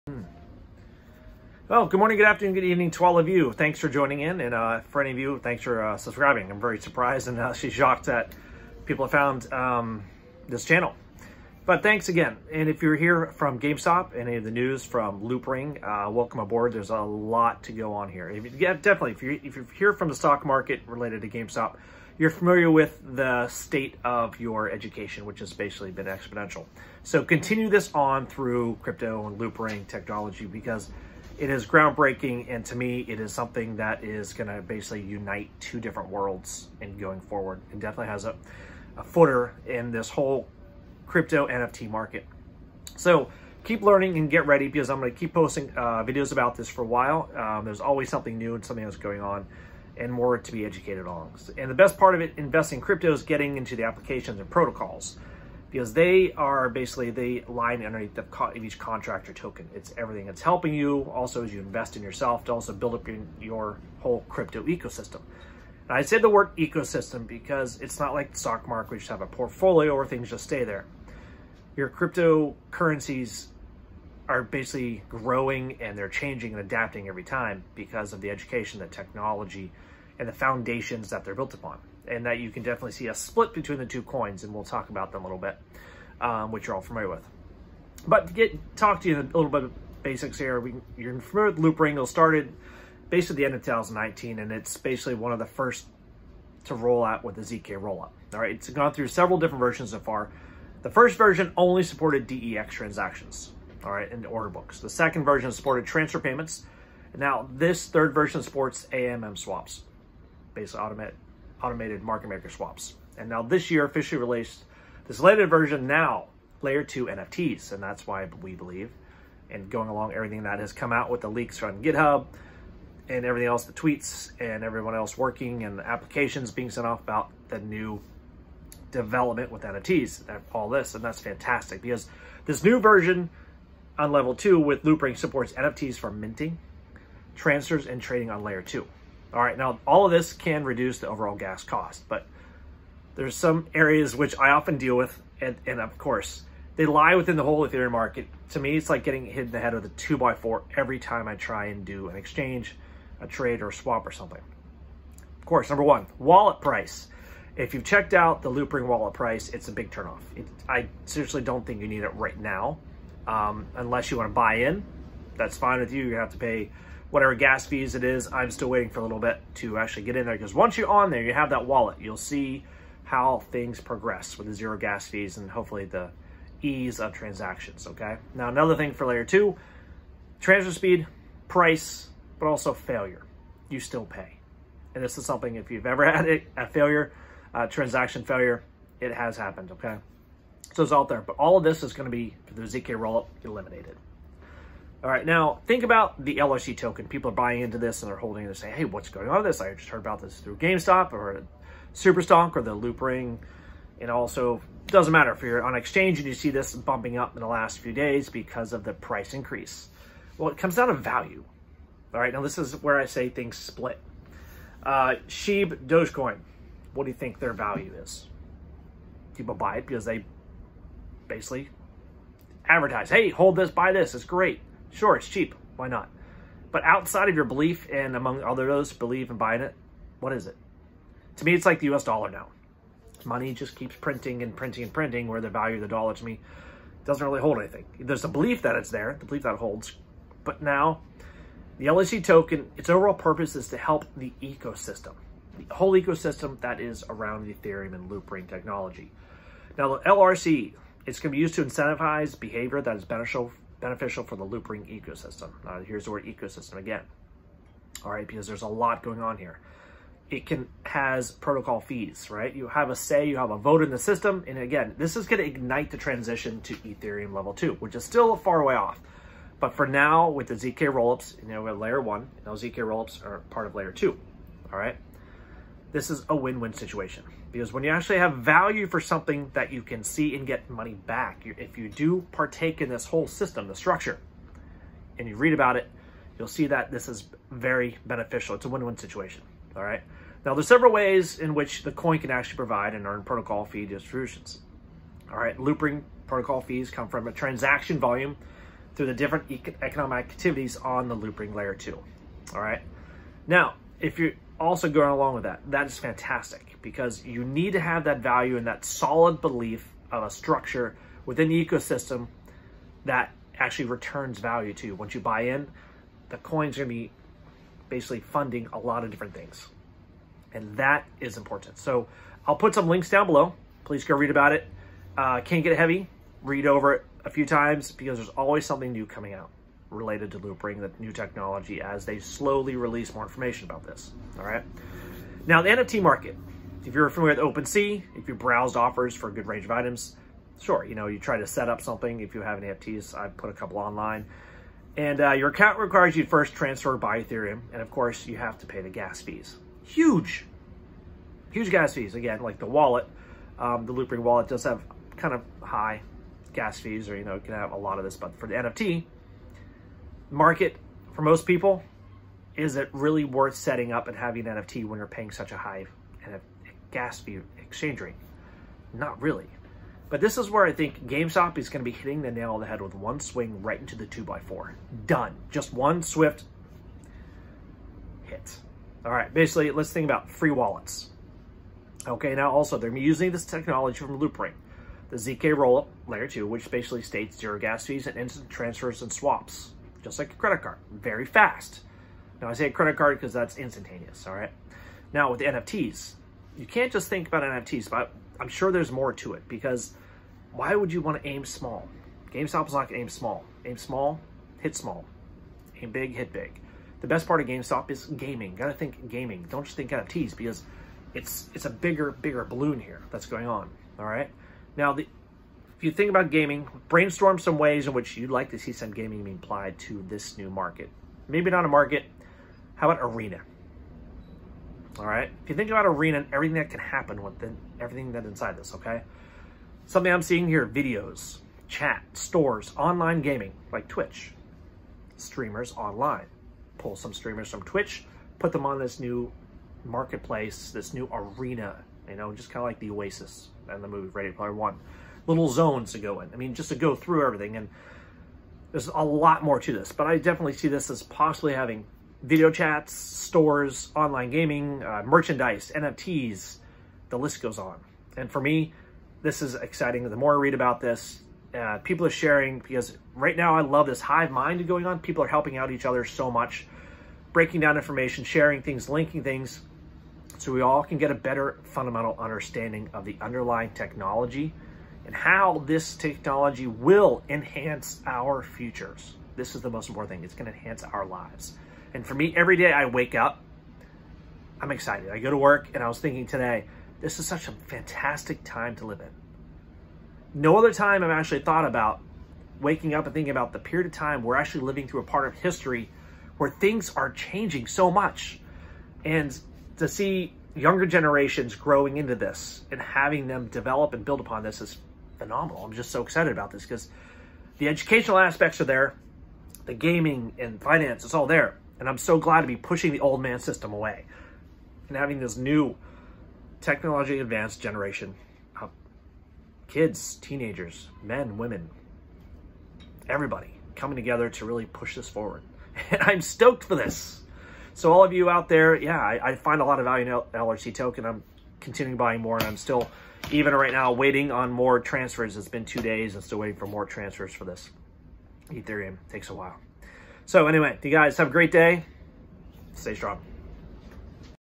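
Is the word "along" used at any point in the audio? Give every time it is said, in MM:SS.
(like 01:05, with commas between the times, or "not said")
01:59, 05:05.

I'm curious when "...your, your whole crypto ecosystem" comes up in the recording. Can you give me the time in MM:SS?
01:03.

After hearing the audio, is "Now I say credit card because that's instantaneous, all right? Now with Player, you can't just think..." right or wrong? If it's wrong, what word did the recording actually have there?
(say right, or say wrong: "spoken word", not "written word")
wrong: "NFTs", not "Player".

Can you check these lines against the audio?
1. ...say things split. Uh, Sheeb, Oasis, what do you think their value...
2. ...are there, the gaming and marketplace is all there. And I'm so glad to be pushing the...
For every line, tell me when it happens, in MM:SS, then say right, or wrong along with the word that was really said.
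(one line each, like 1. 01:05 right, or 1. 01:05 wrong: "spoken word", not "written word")
1. 03:33 wrong: "Dogecoin", not "Oasis"
2. 08:28 wrong: "finance", not "marketplace".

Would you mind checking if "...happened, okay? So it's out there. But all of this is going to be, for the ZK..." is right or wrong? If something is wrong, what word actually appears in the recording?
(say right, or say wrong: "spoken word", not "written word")
right.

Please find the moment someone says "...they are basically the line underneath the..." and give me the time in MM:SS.
00:55.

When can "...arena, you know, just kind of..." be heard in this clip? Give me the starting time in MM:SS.
07:21.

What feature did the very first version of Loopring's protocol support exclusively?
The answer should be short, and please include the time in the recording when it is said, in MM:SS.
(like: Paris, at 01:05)
DEX transactions, at 01:42.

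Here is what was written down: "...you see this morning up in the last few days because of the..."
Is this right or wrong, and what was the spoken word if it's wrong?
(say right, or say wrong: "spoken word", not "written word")
wrong: "bumping", not "morning".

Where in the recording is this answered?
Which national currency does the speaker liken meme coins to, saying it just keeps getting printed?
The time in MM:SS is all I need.
03:51.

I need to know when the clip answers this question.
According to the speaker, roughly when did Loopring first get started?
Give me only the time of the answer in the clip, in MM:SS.
01:33.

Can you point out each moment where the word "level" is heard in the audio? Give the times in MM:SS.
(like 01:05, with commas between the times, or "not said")
02:14, 04:27.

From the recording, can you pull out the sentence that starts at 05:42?
If you have NFTs, I put a couple online.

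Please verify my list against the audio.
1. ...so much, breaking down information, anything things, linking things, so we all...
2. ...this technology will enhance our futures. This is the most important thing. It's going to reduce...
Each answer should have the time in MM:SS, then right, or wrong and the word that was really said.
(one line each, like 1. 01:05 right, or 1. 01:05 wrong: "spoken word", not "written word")
1. 07:46 wrong: "sharing", not "anything"
2. 07:55 wrong: "enhance", not "reduce".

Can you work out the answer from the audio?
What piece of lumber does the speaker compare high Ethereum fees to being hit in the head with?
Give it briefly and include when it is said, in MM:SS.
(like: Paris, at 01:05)
2 by 4, at 02:29.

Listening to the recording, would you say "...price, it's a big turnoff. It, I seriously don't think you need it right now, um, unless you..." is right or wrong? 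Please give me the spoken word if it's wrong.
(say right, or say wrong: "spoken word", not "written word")
right.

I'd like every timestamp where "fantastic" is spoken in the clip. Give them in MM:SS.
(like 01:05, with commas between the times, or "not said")
02:11, 05:05, 08:07.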